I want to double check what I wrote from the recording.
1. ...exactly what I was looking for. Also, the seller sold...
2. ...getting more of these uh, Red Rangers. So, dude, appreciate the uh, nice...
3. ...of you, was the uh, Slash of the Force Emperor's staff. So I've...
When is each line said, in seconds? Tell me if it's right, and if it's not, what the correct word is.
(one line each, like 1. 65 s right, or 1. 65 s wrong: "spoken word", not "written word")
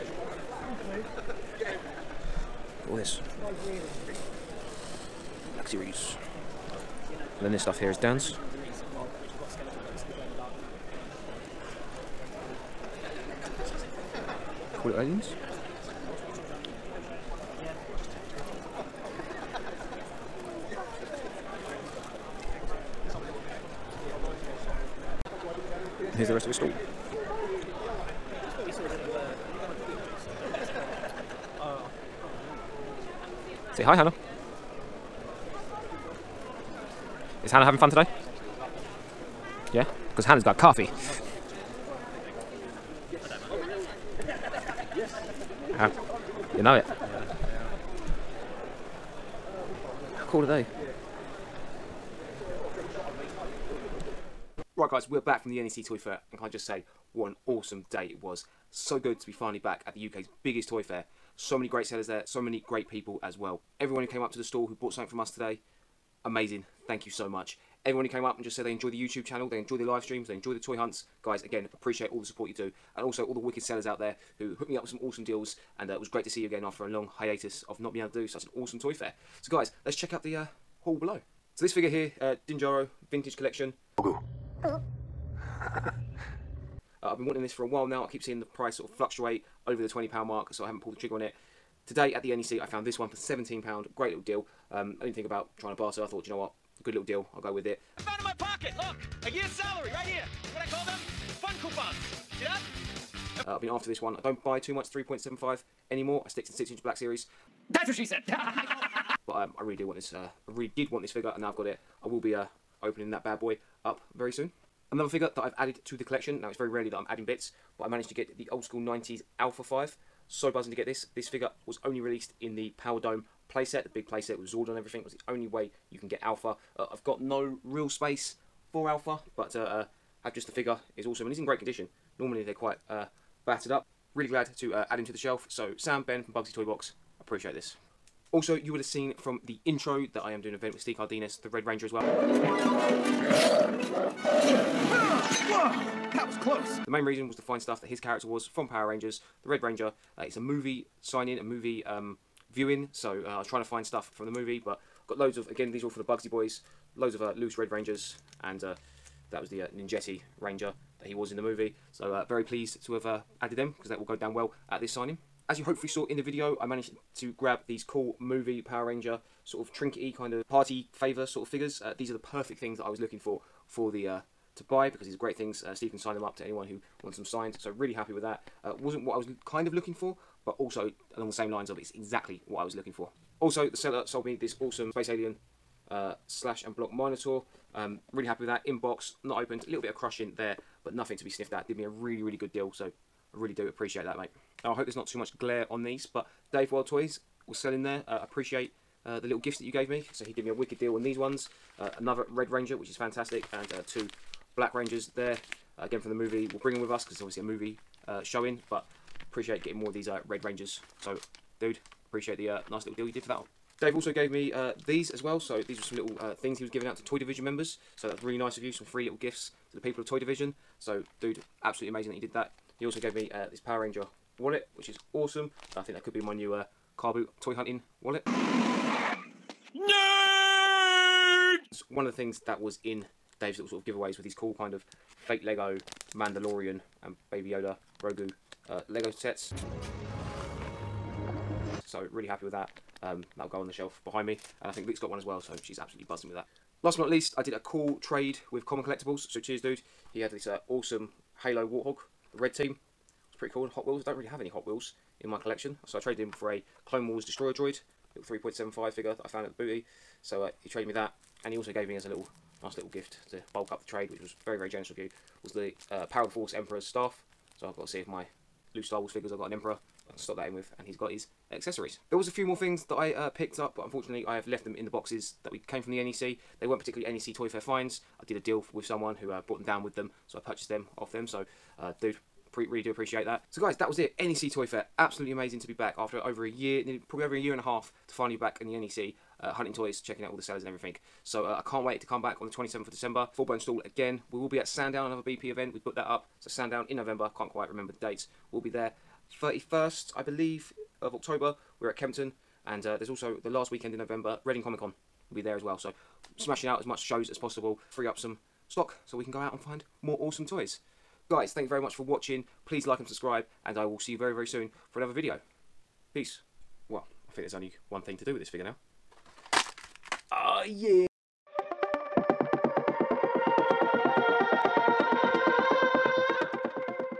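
1. 181 s right
2. 209 s right
3. 264 s wrong: "Power", not "Slash".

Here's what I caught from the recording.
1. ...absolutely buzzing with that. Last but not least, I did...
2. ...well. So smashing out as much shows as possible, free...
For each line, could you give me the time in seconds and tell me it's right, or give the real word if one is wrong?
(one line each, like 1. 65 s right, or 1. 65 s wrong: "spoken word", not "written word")
1. 245 s right
2. 305 s right.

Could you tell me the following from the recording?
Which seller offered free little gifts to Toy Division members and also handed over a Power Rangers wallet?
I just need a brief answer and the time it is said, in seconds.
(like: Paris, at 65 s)
Dave World Toys, at 196 s.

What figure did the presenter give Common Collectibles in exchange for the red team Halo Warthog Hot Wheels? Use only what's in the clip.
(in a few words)
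Clone Wars Destroyer droid.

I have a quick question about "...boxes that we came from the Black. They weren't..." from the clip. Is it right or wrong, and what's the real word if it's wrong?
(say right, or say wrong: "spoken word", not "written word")
wrong: "NEC", not "Black".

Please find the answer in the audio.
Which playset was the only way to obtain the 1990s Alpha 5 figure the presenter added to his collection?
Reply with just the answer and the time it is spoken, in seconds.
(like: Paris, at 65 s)
Power Dome, at 122 s.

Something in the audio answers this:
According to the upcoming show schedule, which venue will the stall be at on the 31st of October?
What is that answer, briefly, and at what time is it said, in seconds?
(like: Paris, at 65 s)
Kempton, at 301 s.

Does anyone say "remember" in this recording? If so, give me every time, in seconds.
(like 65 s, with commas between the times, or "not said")
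297 s.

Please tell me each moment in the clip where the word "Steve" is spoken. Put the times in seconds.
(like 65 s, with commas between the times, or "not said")
140 s, 175 s.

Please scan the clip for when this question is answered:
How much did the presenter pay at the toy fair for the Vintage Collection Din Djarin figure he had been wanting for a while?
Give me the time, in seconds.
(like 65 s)
93 s.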